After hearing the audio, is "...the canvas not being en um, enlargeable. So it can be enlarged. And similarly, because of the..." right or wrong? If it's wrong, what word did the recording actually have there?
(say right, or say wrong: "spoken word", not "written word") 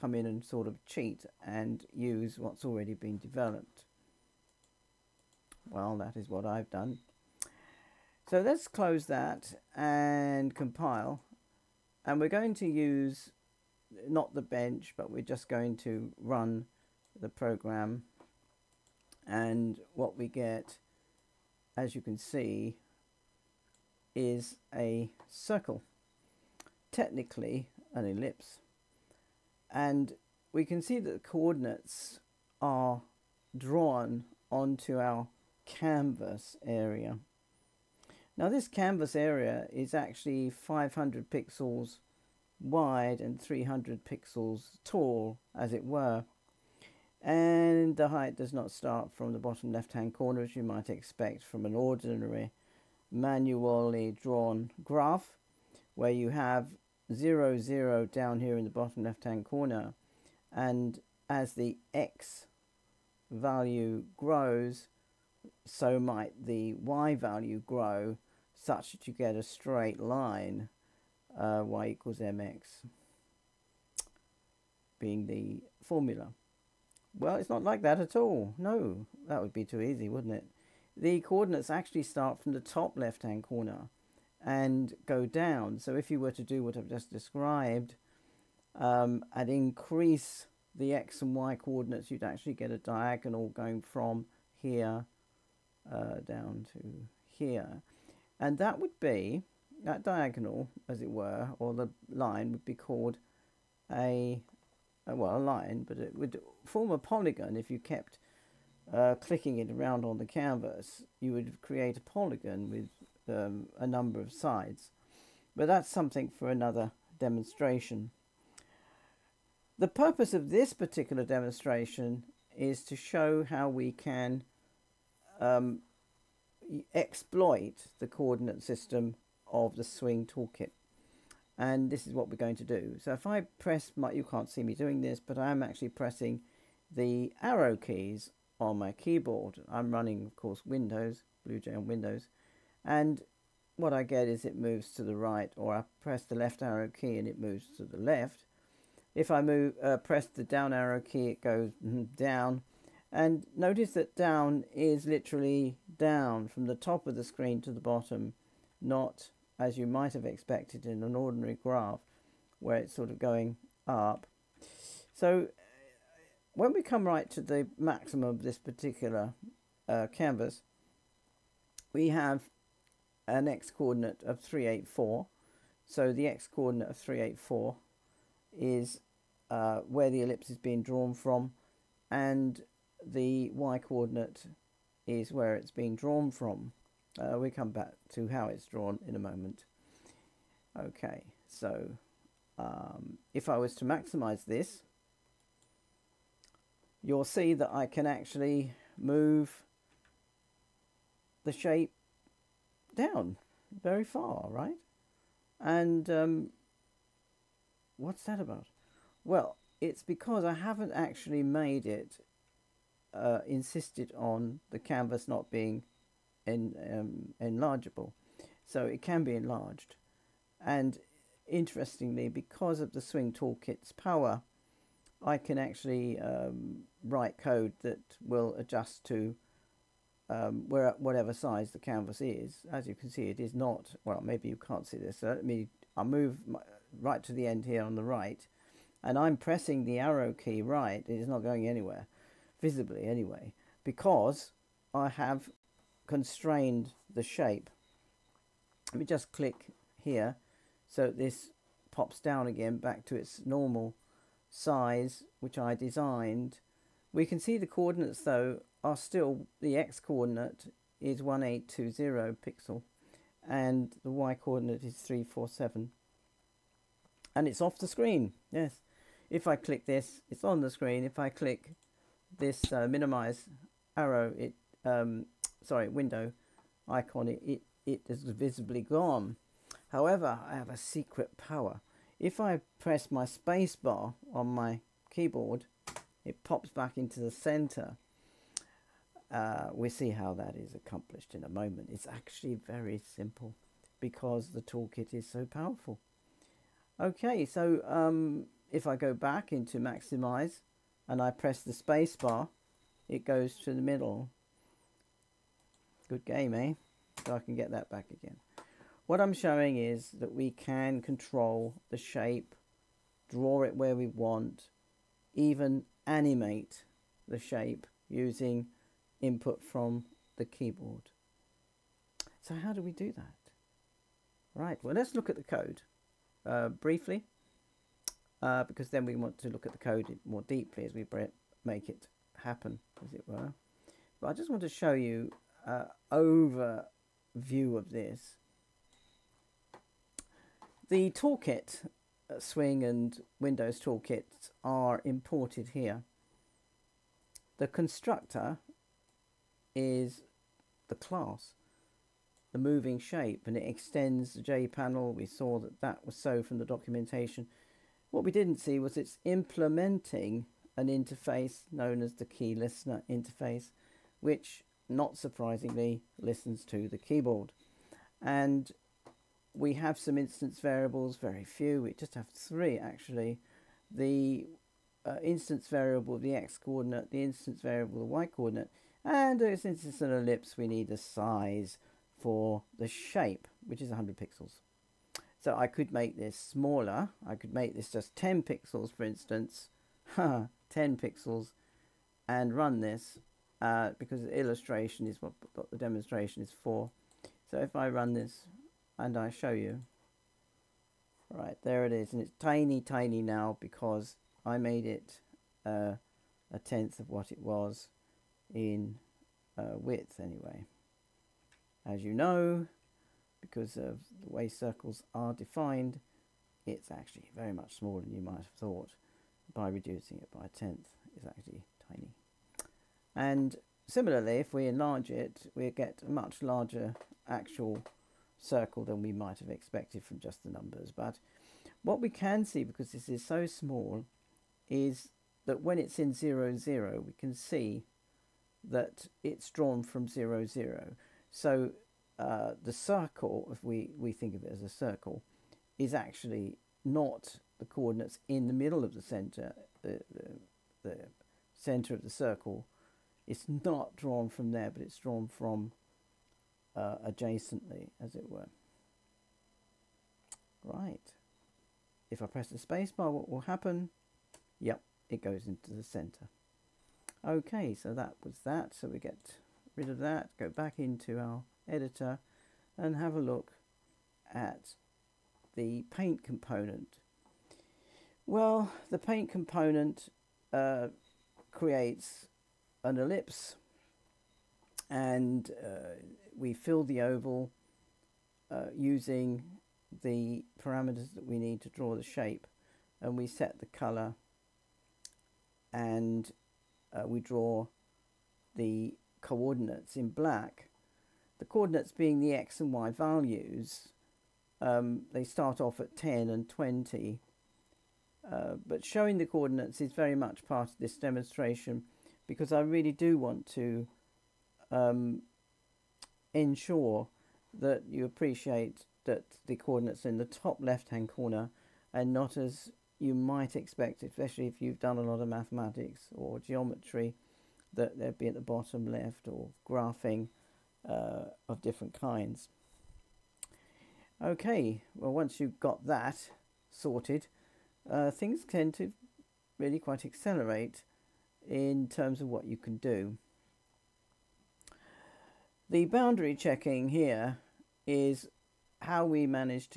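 wrong: "interestingly", not "similarly".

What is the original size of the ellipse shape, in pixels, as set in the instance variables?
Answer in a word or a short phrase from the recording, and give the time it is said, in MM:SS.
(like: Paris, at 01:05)
100, at 06:23.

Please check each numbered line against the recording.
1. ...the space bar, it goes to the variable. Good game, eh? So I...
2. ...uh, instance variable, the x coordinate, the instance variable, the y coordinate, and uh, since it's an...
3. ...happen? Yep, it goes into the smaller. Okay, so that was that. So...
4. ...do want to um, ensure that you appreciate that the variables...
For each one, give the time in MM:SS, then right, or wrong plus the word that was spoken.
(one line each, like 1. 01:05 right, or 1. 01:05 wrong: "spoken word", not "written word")
1. 05:01 wrong: "middle", not "variable"
2. 06:15 right
3. 07:43 wrong: "center", not "smaller"
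4. 08:32 wrong: "coordinates", not "variables".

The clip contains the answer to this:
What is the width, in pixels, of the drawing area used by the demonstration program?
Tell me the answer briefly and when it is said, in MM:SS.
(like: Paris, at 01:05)
500, at 00:40.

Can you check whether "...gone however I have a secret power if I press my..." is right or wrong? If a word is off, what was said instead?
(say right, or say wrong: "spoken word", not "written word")
right.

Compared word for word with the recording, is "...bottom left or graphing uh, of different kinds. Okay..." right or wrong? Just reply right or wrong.
right.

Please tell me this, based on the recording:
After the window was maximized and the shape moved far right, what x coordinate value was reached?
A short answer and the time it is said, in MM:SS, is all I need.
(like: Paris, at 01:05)
1820, at 04:21.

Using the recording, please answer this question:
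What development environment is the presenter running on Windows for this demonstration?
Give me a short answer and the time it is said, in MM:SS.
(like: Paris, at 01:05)
BlueJ, at 02:21.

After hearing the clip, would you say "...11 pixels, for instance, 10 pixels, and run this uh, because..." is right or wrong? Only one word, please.
wrong.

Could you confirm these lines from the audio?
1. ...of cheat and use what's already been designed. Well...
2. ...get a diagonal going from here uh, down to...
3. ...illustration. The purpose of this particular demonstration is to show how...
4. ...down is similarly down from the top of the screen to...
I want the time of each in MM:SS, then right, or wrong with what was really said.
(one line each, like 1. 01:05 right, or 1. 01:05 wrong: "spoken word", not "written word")
1. 00:00 wrong: "developed", not "designed"
2. 01:32 right
3. 01:57 wrong: "demonstration", not "illustration"
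4. 02:34 wrong: "literally", not "similarly".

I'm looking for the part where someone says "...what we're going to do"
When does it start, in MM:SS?
02:12.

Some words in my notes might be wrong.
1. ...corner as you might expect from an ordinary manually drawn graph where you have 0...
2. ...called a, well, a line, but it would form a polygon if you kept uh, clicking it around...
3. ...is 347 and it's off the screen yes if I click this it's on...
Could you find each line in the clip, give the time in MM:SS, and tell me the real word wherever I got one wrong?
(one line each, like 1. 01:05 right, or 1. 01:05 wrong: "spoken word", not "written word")
1. 00:50 right
2. 01:42 right
3. 04:24 right.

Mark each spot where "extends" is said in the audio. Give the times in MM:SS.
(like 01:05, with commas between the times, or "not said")
05:53.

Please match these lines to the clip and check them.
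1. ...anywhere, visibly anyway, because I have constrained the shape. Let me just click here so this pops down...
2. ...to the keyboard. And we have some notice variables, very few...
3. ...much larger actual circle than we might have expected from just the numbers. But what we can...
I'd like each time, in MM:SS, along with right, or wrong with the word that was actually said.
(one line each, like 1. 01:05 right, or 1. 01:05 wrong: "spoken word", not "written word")
1. 04:01 right
2. 06:06 wrong: "instance", not "notice"
3. 07:06 right.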